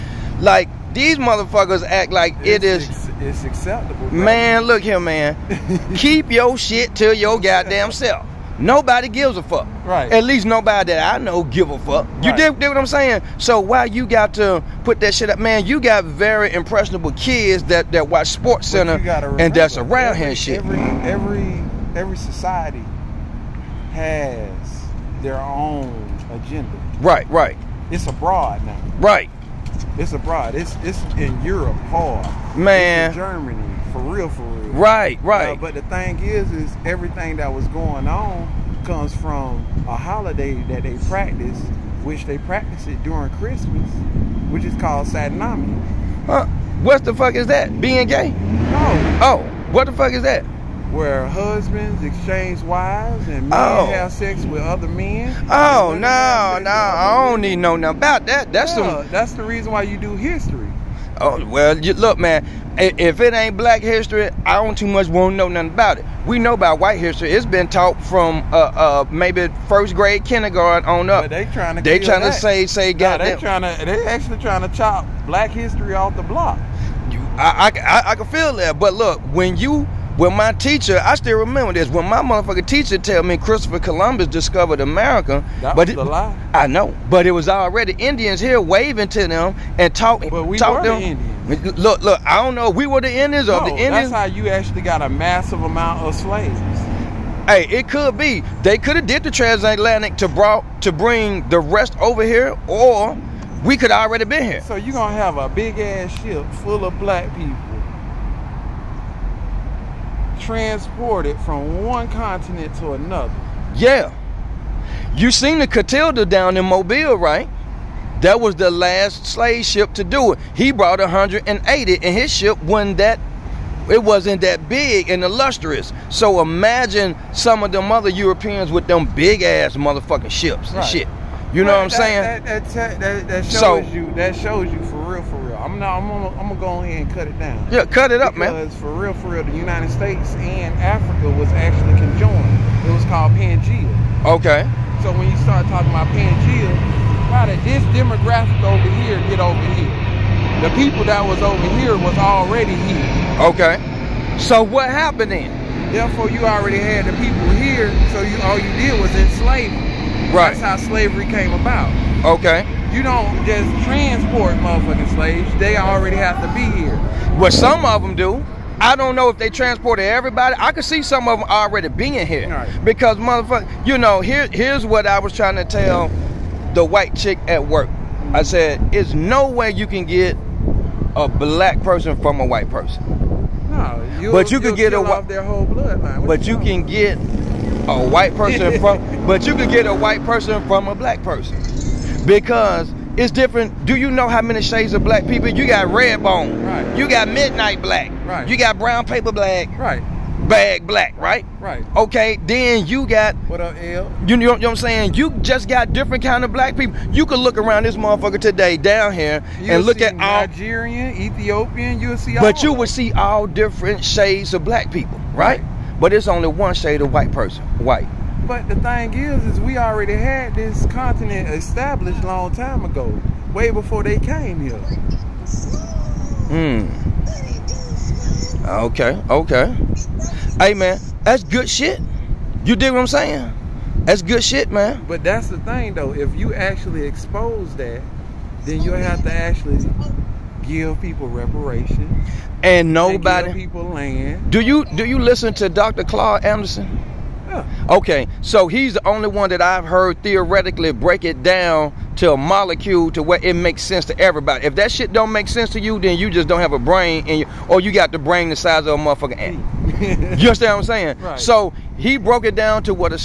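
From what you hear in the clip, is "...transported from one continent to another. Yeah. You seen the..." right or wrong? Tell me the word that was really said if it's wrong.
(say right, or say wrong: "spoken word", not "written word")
right.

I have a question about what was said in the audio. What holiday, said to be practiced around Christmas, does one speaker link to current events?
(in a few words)
Saturnalia.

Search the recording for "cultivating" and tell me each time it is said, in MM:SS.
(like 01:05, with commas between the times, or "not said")
not said.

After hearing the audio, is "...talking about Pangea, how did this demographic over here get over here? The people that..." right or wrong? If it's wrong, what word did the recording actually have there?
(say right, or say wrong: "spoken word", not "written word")
right.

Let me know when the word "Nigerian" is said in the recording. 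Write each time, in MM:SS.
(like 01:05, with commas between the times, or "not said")
03:30.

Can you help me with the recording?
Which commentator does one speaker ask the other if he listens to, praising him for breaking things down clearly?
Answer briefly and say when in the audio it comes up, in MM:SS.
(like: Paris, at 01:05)
Dr. Claude Anderson, at 04:05.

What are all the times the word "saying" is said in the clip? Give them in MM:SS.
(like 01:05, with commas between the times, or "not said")
00:12, 02:12, 03:24, 03:53, 04:20.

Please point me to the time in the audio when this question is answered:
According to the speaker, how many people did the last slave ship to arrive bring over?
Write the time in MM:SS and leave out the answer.
02:00.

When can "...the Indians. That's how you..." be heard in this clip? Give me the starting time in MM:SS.
01:33.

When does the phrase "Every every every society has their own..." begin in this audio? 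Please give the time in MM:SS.
00:20.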